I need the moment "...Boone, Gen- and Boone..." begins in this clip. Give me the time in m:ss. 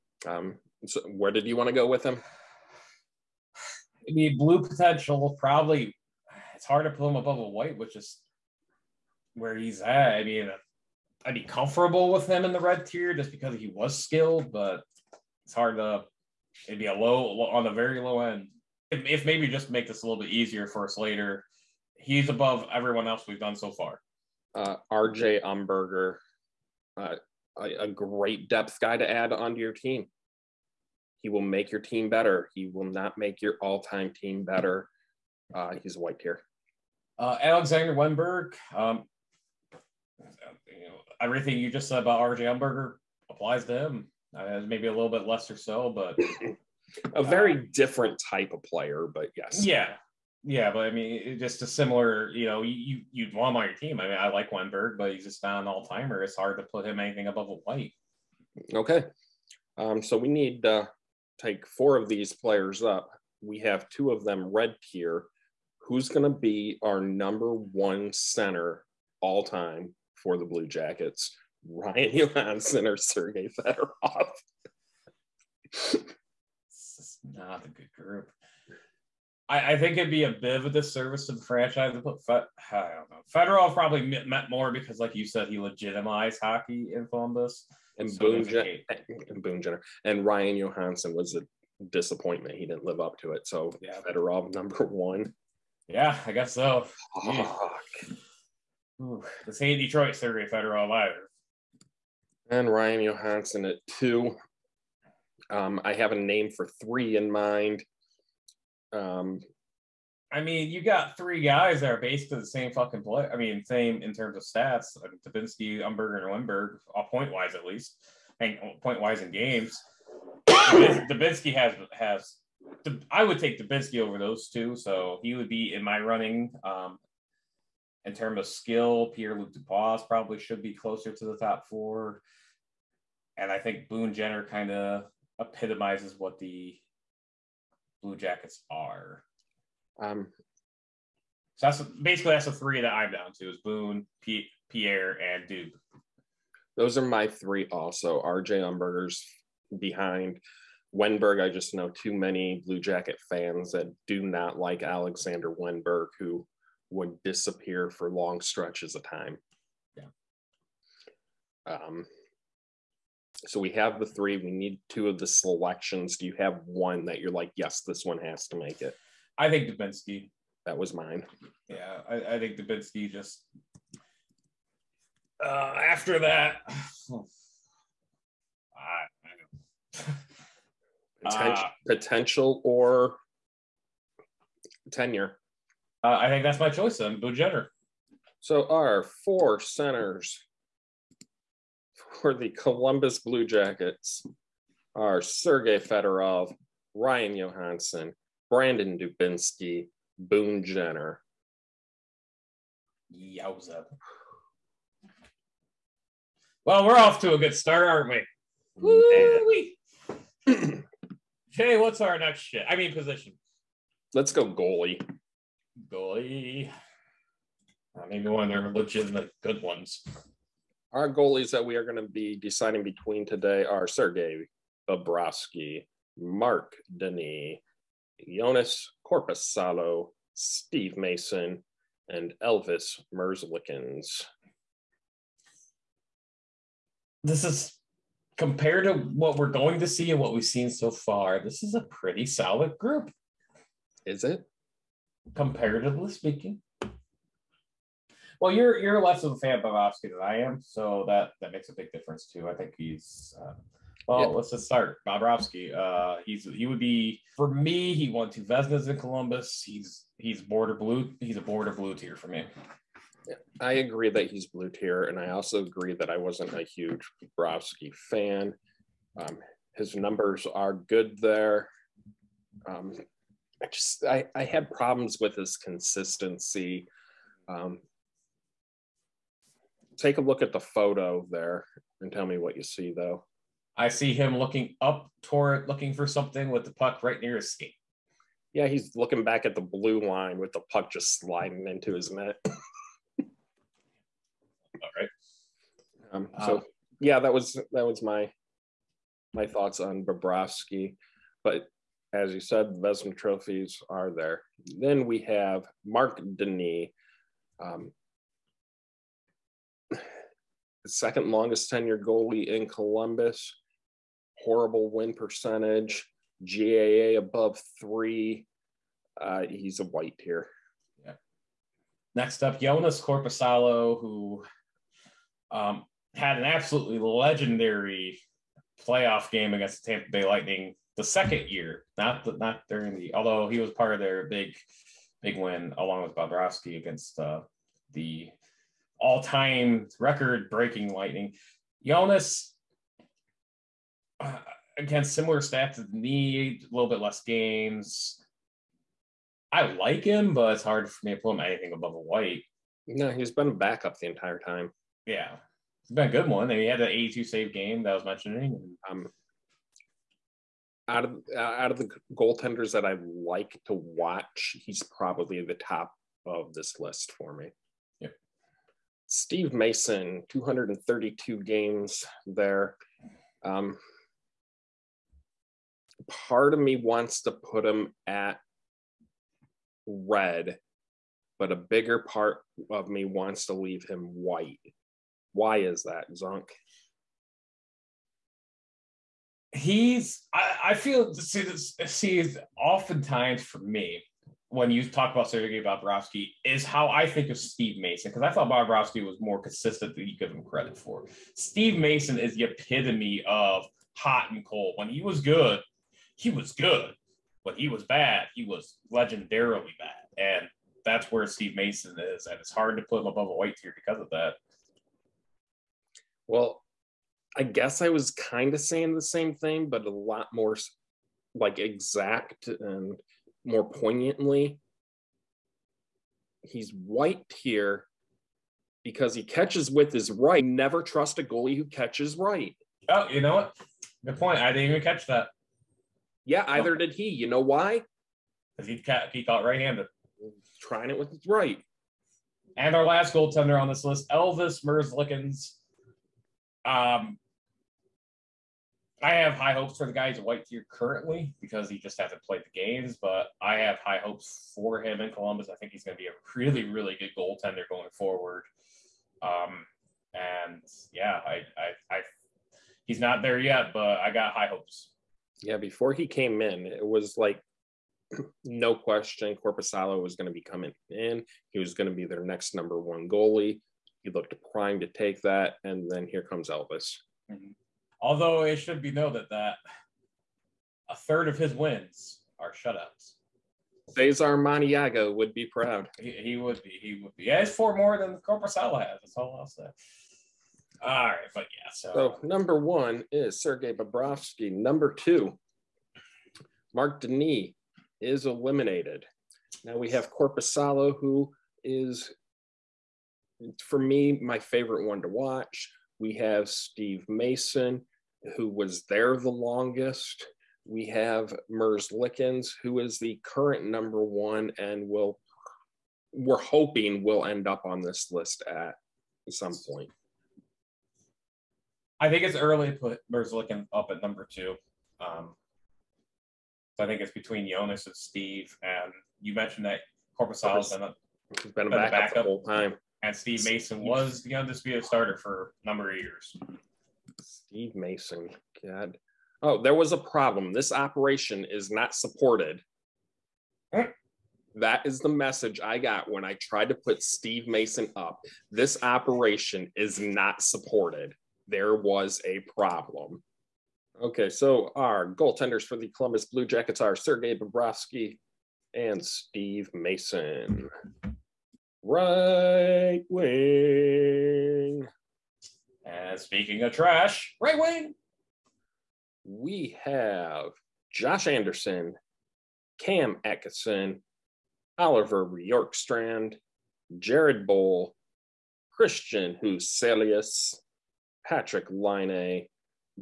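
1:28.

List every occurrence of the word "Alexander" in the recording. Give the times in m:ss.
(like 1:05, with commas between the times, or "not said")
0:37, 2:34.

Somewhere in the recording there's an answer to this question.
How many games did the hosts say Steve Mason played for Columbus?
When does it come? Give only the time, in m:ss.
6:10.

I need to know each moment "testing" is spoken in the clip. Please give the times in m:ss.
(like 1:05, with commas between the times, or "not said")
not said.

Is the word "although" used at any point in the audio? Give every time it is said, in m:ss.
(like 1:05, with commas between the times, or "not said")
5:33, 7:57.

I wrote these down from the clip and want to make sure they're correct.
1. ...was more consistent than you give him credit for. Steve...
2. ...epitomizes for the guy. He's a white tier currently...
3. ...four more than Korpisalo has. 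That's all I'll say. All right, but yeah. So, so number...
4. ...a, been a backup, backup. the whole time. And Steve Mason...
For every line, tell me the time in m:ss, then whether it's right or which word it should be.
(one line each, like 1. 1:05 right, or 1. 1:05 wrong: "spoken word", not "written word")
1. 6:39 right
2. 7:29 wrong: "hopes", not "epitomizes"
3. 8:07 right
4. 8:50 right.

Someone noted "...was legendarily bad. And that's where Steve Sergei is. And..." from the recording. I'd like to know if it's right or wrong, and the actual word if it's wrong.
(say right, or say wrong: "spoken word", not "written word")
wrong: "Mason", not "Sergei".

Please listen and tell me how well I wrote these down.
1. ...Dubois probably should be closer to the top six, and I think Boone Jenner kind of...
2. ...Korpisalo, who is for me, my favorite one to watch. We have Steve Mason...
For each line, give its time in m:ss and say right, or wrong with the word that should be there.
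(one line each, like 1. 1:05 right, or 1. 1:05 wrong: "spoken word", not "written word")
1. 2:09 wrong: "four", not "six"
2. 8:20 right.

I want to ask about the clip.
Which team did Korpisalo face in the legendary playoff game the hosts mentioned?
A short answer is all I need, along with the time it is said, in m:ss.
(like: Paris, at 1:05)
Tampa Bay Lightning, at 5:29.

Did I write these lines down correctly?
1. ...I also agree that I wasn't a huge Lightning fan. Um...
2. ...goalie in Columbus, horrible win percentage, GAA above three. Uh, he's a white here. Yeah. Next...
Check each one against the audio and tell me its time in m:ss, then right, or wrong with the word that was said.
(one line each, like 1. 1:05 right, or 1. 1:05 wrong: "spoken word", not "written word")
1. 4:25 wrong: "Bobrovsky", not "Lightning"
2. 5:11 right.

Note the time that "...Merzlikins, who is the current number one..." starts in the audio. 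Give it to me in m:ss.
8:31.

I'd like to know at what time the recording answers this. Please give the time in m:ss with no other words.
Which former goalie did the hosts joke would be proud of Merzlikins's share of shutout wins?
8:03.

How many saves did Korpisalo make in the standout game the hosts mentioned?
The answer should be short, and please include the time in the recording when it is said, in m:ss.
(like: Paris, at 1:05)
82, at 5:56.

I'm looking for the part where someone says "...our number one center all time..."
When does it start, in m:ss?
1:06.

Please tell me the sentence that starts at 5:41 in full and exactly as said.
Jonas uh, again similar stats to need a little bit less games.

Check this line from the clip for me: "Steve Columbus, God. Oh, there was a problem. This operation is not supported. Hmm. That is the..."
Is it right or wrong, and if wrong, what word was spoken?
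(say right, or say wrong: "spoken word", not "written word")
wrong: "Mason", not "Columbus".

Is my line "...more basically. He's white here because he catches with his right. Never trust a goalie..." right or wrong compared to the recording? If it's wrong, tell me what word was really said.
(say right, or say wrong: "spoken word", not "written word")
wrong: "poignantly", not "basically".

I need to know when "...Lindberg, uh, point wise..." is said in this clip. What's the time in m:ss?
1:56.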